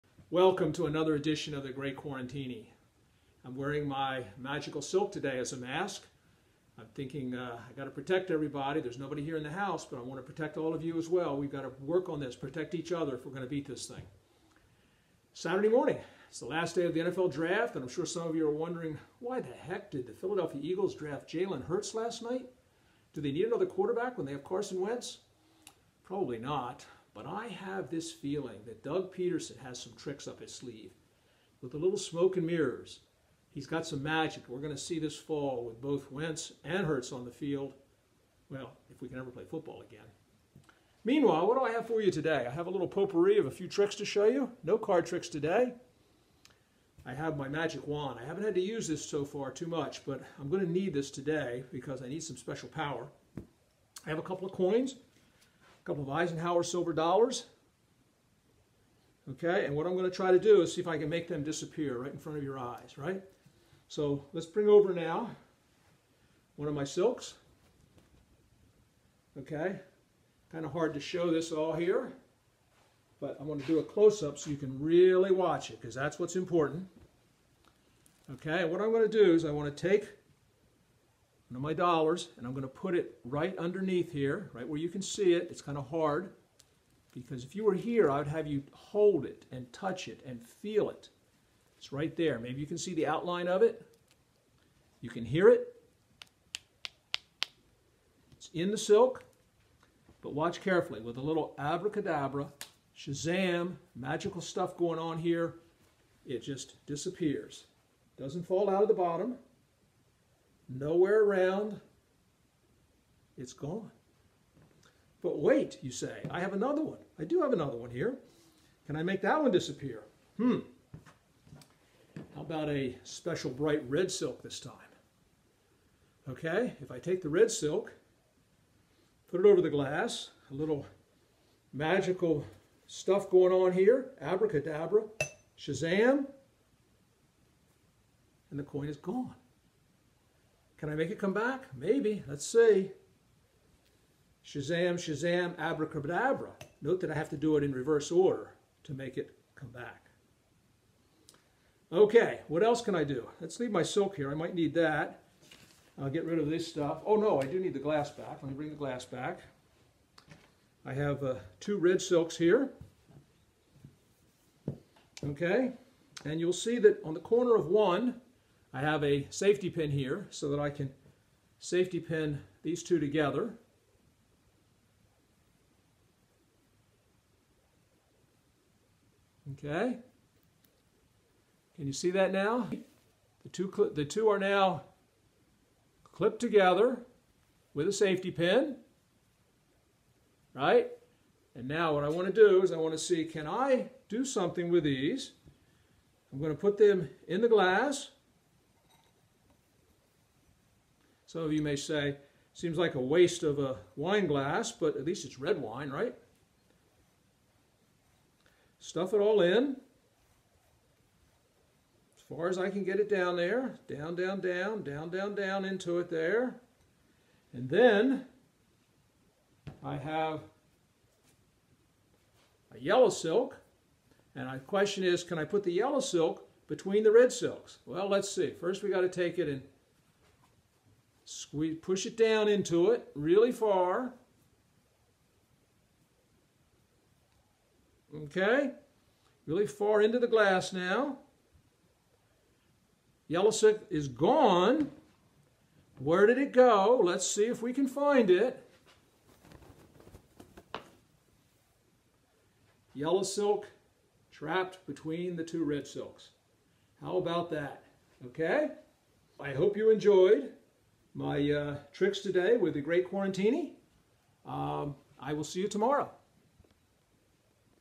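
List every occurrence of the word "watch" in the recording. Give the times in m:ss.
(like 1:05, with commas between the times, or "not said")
1:15, 1:40.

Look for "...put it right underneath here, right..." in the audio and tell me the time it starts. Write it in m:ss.
1:22.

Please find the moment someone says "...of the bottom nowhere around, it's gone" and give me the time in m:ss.
1:48.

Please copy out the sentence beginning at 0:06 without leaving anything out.
I'm thinking uh, I got to protect everybody.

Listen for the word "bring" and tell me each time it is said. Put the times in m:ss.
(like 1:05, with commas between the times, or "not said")
1:04, 2:38.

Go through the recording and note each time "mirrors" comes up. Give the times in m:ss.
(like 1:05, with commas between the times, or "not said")
0:32.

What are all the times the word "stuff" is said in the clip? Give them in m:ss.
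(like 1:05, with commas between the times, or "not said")
1:44, 2:12, 2:36, 3:28.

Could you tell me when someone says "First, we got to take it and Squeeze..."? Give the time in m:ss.
3:48.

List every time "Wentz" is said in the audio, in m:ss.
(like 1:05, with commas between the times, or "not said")
0:24, 0:36.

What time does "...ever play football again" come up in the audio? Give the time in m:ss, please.
0:39.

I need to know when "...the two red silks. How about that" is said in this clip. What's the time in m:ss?
4:15.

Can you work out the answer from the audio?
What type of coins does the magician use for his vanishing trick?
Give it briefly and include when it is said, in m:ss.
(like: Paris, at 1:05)
Eisenhower silver dollars, at 0:56.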